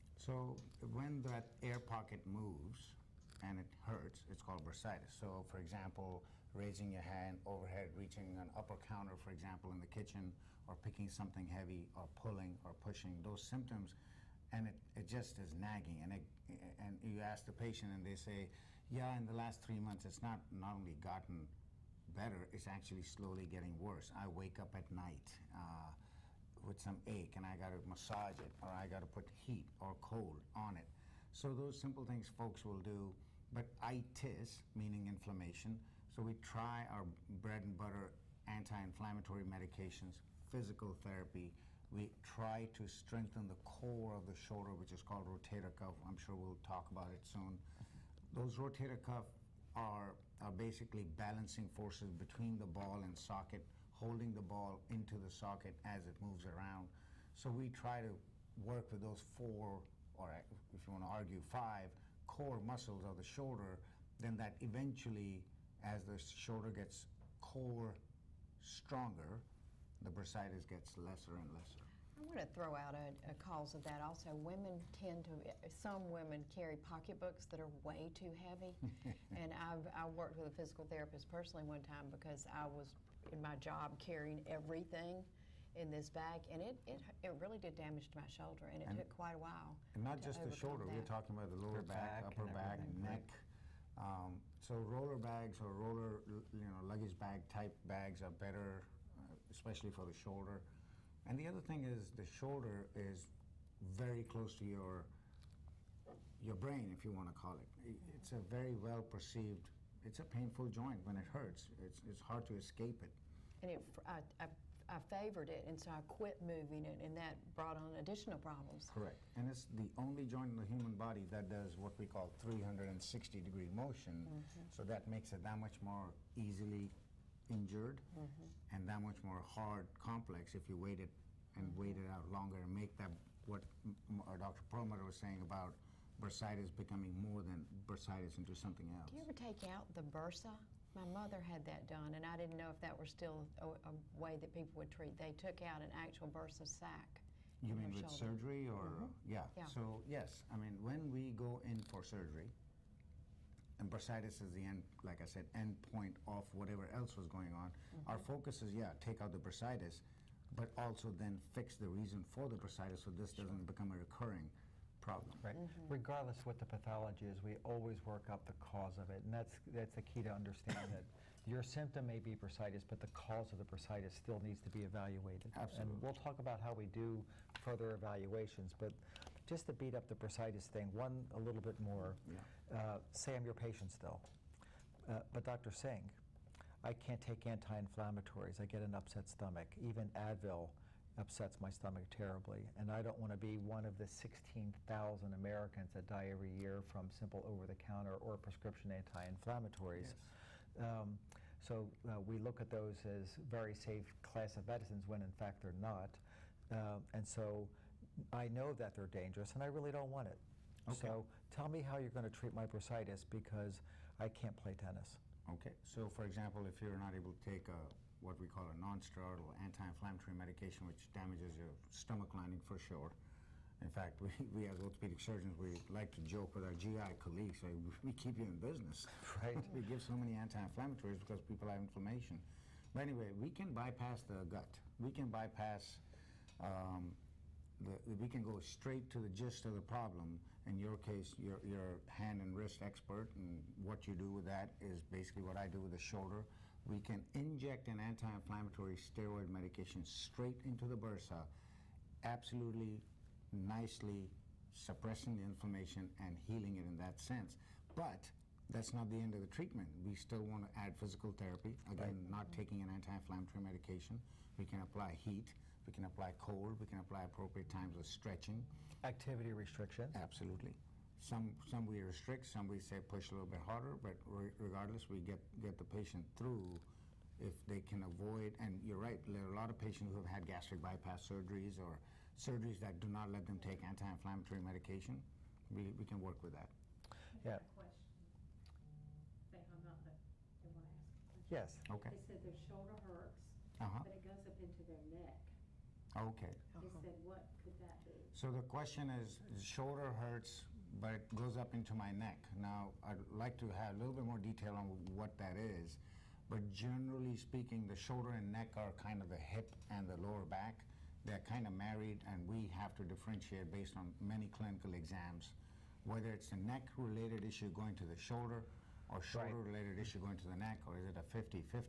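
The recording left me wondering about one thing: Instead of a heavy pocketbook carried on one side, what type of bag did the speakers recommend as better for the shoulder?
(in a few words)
roller bags.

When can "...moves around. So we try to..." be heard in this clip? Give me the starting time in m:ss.
0:56.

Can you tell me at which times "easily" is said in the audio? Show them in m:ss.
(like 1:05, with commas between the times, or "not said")
2:06.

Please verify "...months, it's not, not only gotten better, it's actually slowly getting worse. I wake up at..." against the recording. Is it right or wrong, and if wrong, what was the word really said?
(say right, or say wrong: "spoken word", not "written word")
right.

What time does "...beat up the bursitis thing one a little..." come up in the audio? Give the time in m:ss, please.
2:59.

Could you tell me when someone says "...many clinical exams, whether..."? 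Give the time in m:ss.
5:14.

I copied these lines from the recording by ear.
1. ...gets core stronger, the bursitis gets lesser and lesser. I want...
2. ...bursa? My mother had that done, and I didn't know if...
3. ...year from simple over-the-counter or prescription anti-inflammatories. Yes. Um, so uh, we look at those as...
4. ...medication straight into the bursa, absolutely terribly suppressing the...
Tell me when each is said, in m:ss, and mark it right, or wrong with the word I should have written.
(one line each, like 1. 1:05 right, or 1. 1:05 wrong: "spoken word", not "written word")
1. 1:06 right
2. 2:20 right
3. 3:16 right
4. 4:09 wrong: "nicely", not "terribly".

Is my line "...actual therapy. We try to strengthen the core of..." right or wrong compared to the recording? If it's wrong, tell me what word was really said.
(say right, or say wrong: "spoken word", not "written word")
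wrong: "physical", not "actual".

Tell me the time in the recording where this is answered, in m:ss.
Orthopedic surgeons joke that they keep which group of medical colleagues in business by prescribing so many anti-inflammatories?
3:46.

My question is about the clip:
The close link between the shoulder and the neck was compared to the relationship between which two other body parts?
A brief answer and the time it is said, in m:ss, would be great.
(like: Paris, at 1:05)
the hip and the lower back, at 5:09.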